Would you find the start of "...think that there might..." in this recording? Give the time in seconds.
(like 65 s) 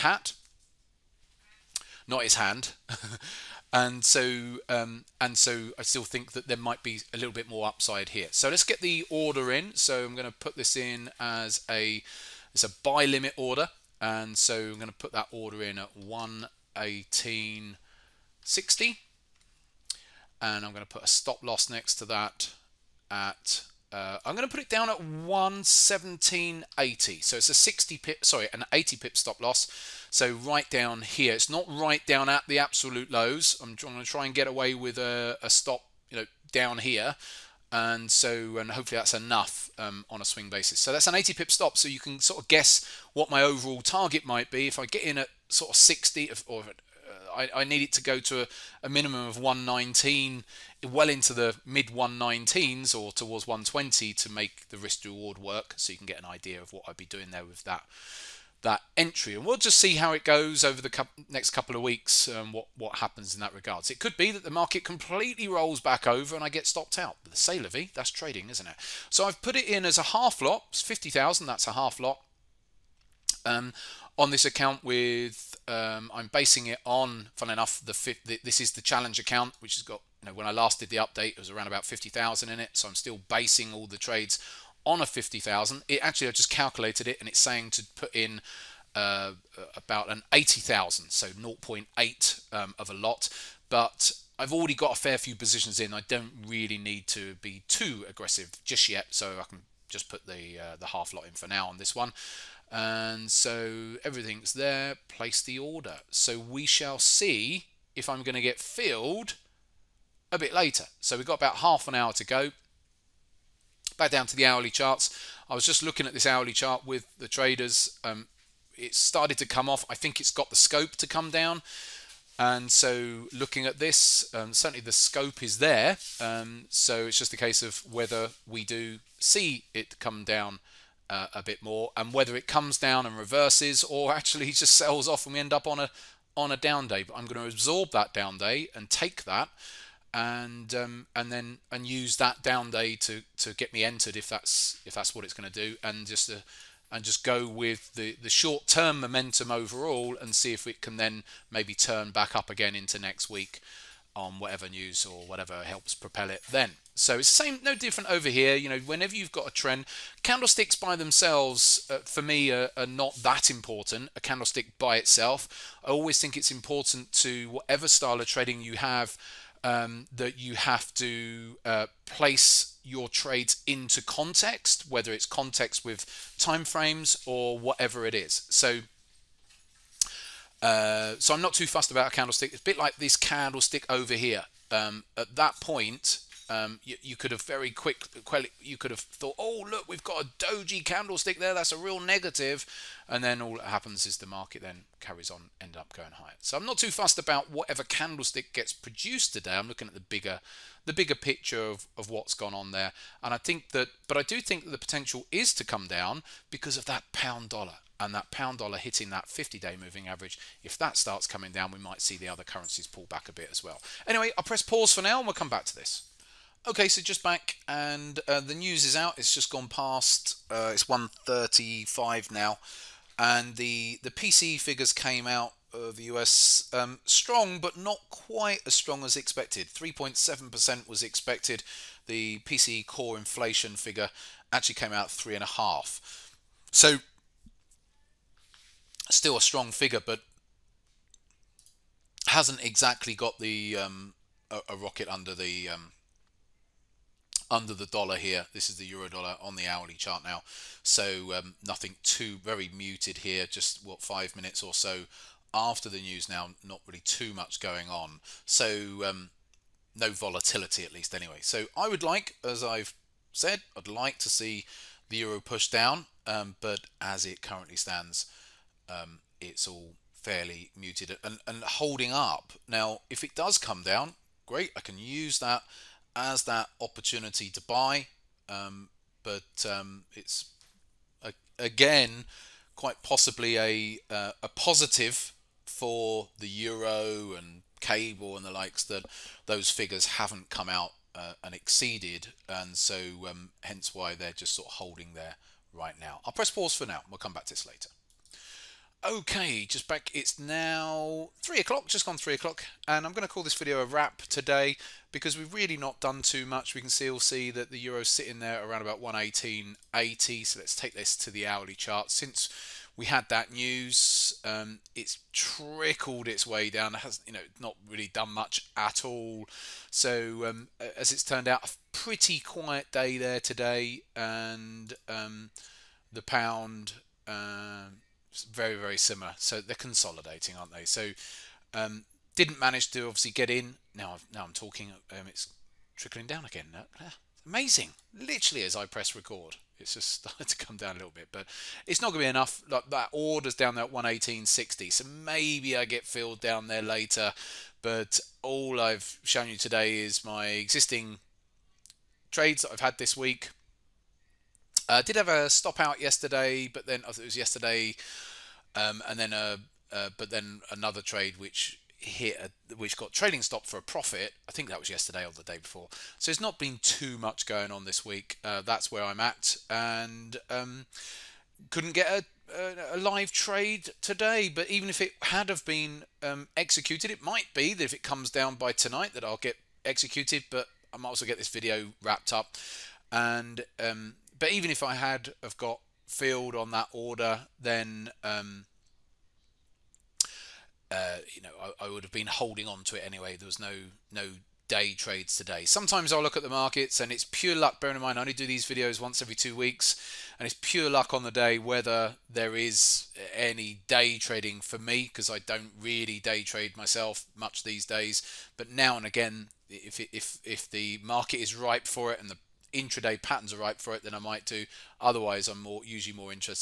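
6 s.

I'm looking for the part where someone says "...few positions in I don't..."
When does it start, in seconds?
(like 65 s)
95 s.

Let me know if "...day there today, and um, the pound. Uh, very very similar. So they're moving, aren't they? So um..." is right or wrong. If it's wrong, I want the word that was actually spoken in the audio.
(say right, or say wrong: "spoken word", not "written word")
wrong: "consolidating", not "moving".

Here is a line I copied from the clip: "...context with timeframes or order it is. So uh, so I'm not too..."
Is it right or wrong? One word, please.
wrong.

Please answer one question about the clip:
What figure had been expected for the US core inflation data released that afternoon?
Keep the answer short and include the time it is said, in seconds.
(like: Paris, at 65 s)
3.7%, at 229 s.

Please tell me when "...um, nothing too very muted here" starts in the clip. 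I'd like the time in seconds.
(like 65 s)
251 s.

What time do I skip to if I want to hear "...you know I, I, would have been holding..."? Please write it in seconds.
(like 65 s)
391 s.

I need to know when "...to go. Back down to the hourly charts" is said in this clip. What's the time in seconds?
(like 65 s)
112 s.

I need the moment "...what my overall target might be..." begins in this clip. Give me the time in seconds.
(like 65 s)
43 s.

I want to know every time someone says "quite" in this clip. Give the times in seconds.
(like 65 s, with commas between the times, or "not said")
228 s, 282 s.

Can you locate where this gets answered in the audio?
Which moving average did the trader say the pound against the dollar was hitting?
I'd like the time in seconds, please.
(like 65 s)
209 s.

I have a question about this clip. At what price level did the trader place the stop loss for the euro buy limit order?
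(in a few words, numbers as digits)
117.80.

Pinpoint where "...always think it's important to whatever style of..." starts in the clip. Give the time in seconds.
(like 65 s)
165 s.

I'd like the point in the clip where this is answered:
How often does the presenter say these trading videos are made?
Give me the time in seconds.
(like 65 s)
398 s.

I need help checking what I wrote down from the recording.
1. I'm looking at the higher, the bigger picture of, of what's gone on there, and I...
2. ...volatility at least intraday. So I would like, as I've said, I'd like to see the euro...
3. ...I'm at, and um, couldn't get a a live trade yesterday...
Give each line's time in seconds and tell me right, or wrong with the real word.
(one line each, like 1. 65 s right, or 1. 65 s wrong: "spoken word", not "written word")
1. 199 s wrong: "bigger", not "higher"
2. 260 s wrong: "anyway", not "intraday"
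3. 369 s wrong: "today", not "yesterday".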